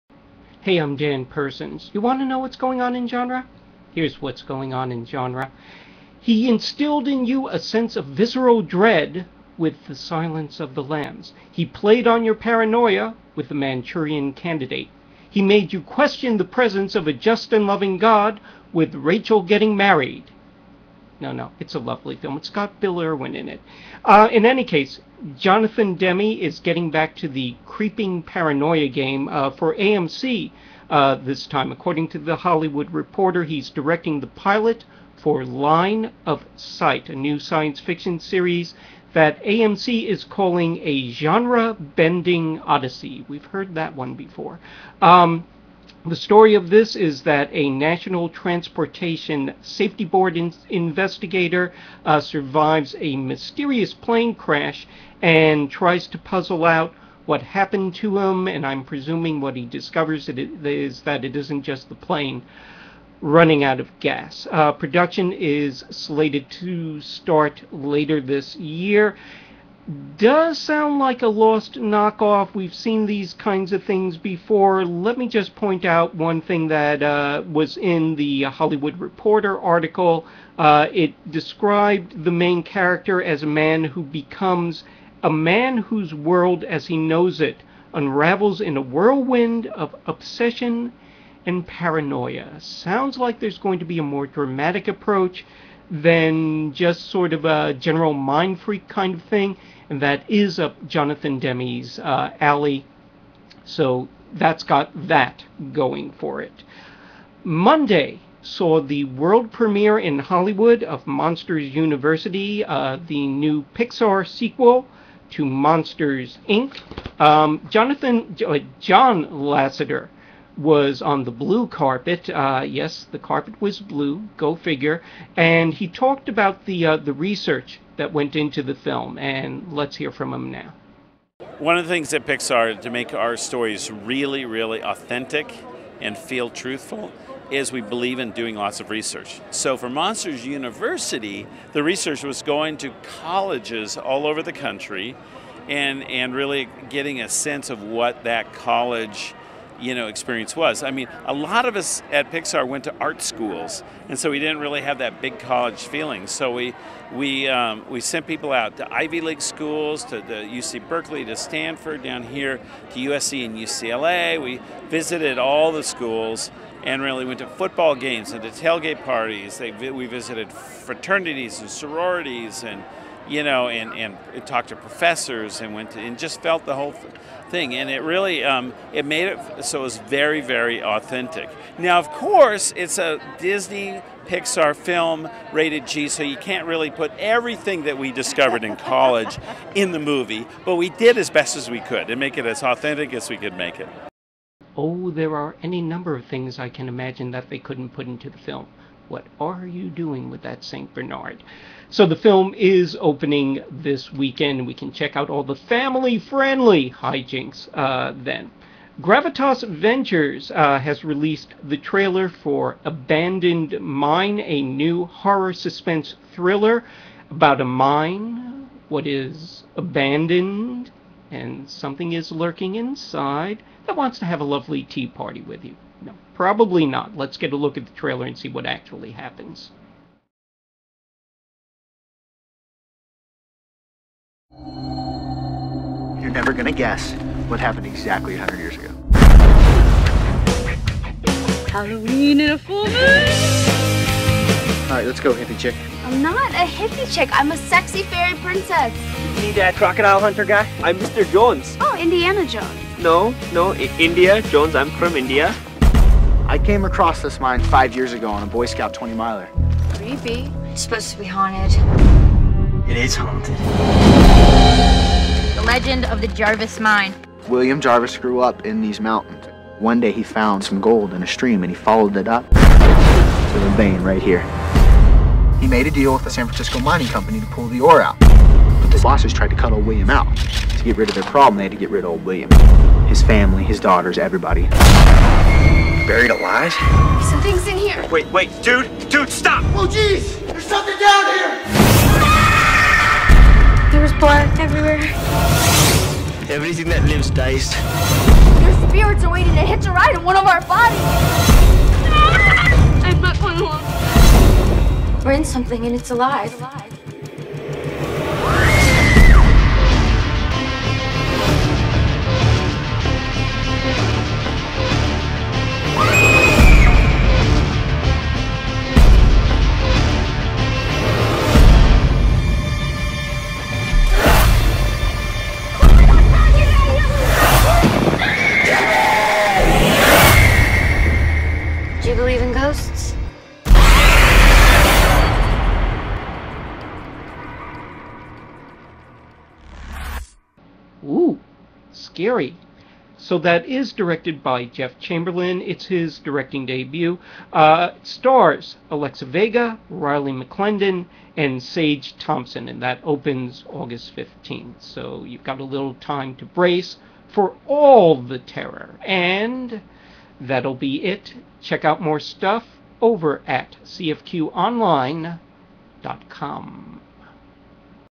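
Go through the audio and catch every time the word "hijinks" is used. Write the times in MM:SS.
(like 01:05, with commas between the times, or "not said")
03:26.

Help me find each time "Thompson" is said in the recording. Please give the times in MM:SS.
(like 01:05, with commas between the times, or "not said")
05:52.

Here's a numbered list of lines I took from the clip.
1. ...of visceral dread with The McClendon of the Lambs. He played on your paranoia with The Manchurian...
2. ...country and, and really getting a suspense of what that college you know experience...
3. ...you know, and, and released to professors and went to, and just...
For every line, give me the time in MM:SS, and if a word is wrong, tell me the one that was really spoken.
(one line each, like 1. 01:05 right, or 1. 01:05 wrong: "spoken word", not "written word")
1. 00:07 wrong: "Silence", not "McClendon"
2. 02:24 wrong: "sense", not "suspense"
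3. 02:53 wrong: "talked", not "released".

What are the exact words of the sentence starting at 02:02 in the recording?
Uh, yes, the carpet was blue.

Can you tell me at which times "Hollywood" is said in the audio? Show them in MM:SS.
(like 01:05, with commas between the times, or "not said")
00:32, 01:18, 01:50.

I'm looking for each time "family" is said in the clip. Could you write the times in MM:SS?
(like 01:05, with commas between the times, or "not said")
03:25, 04:43.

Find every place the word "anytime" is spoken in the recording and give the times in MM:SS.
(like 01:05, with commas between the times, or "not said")
not said.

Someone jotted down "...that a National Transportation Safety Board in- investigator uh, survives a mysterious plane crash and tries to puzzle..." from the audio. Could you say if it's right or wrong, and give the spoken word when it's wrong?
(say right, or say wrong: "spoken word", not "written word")
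right.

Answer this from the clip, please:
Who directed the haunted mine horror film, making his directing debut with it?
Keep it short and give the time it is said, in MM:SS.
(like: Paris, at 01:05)
Jeff Chamberlain, at 05:44.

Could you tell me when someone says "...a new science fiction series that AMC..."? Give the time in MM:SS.
00:37.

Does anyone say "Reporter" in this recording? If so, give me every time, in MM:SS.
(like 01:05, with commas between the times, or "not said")
00:32, 01:18.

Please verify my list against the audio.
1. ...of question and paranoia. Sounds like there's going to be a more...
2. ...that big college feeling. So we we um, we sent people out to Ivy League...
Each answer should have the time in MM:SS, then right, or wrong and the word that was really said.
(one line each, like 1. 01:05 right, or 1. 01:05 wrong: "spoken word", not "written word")
1. 01:29 wrong: "obsession", not "question"
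2. 02:34 right.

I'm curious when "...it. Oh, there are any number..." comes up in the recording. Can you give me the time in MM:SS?
03:13.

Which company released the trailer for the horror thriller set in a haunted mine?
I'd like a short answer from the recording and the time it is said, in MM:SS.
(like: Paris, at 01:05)
Gravitas Ventures, at 03:29.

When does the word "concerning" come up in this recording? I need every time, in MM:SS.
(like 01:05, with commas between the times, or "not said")
not said.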